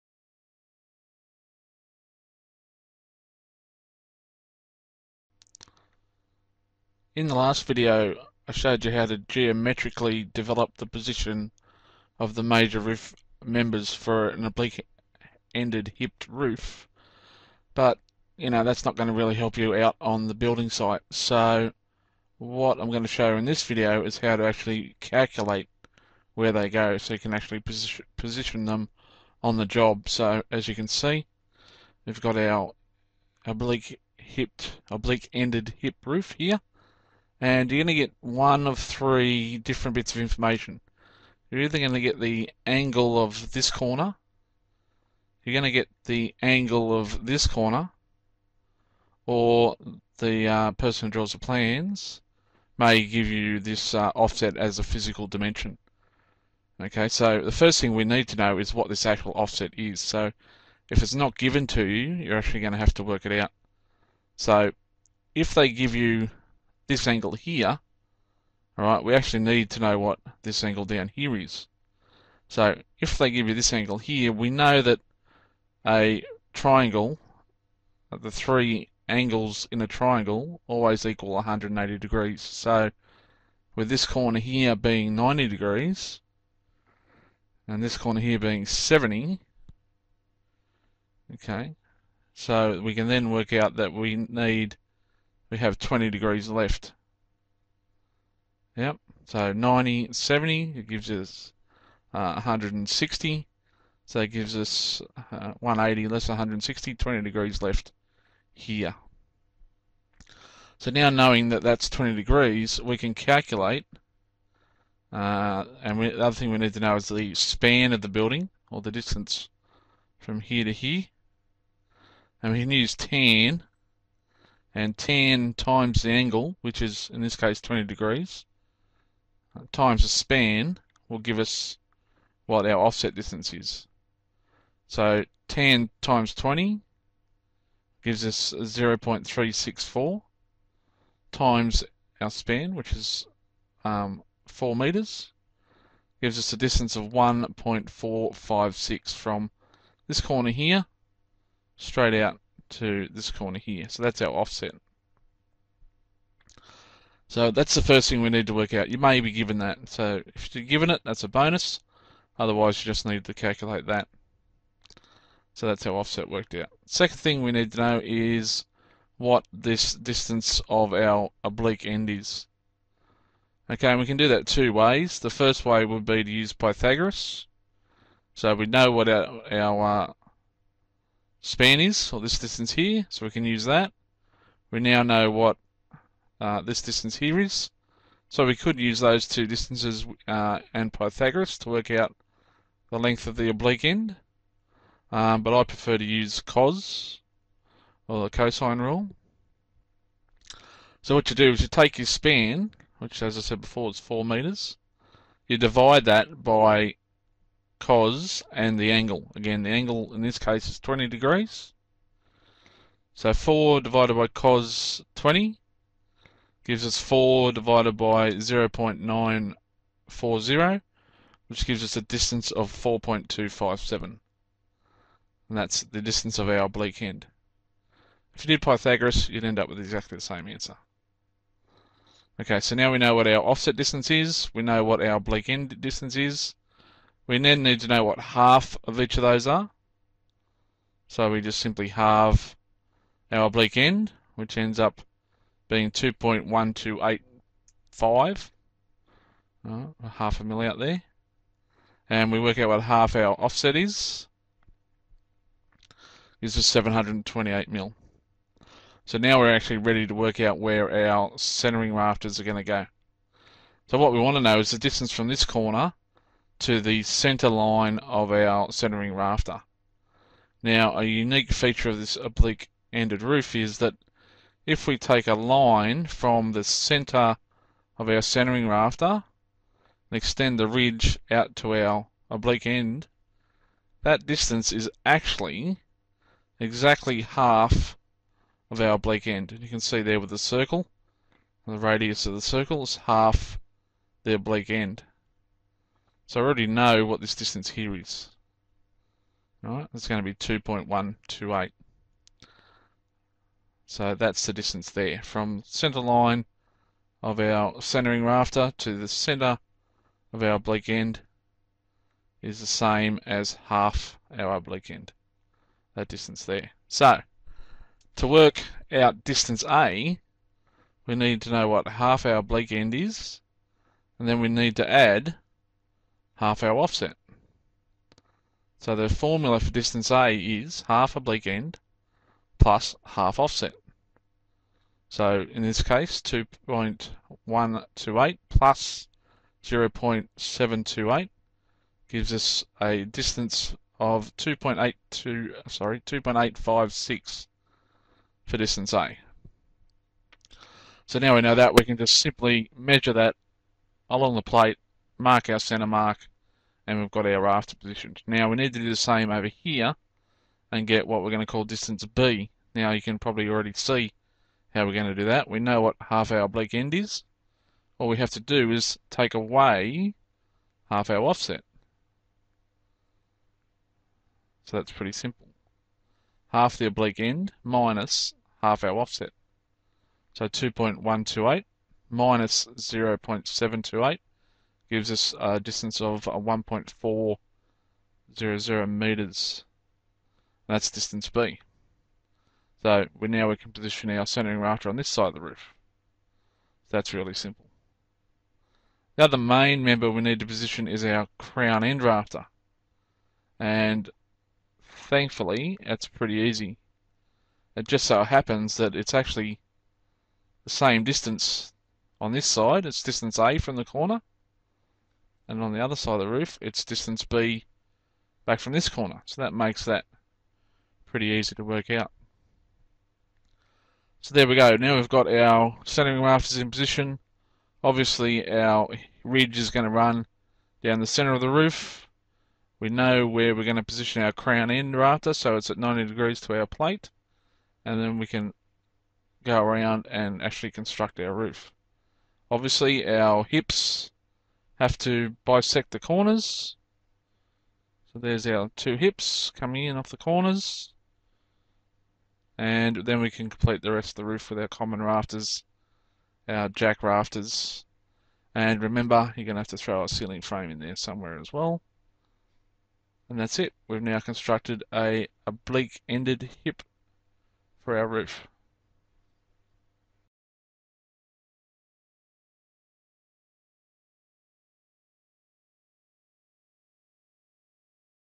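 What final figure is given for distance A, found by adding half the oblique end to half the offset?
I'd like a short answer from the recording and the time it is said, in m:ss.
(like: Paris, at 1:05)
2.856, at 5:46.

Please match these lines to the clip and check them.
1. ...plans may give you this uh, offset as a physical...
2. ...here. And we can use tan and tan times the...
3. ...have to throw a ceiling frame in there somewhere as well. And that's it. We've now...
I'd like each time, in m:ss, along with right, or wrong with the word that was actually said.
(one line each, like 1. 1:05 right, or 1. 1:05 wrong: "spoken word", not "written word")
1. 0:51 right
2. 2:00 right
3. 7:39 right.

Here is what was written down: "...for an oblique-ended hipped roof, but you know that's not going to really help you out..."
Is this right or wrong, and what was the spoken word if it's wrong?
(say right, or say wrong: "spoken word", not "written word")
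right.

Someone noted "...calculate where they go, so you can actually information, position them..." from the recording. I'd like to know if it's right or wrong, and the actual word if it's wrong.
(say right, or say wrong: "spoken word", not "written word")
wrong: "position", not "information".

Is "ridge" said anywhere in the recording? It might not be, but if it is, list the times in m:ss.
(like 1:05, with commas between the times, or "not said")
4:40, 7:09.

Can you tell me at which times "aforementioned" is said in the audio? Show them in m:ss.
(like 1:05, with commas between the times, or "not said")
not said.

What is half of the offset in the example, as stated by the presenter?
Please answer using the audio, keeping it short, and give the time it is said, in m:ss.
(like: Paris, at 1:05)
728 mil, at 4:16.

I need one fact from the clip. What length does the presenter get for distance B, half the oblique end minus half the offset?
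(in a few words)
1.400 metres.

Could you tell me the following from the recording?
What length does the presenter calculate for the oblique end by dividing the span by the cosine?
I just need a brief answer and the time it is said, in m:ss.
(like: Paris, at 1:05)
4.257, at 3:42.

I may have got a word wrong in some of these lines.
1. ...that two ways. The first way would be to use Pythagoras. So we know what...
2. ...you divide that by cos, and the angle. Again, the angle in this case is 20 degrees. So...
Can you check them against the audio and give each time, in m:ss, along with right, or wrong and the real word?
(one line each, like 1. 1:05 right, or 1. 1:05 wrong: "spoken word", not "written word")
1. 2:54 right
2. 3:25 right.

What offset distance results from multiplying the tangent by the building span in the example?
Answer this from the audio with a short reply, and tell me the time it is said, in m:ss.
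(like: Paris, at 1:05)
1.456, at 2:27.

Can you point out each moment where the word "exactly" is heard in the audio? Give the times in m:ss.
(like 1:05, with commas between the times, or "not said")
3:49, 4:46.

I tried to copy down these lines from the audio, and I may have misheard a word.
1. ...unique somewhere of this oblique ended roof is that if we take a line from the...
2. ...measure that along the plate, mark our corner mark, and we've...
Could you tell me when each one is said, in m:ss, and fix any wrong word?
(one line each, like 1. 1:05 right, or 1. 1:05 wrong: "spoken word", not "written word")
1. 4:31 wrong: "feature", not "somewhere"
2. 5:52 wrong: "center", not "corner".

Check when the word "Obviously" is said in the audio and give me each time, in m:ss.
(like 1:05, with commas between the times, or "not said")
7:07, 7:22.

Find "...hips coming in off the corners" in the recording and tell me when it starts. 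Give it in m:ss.
7:28.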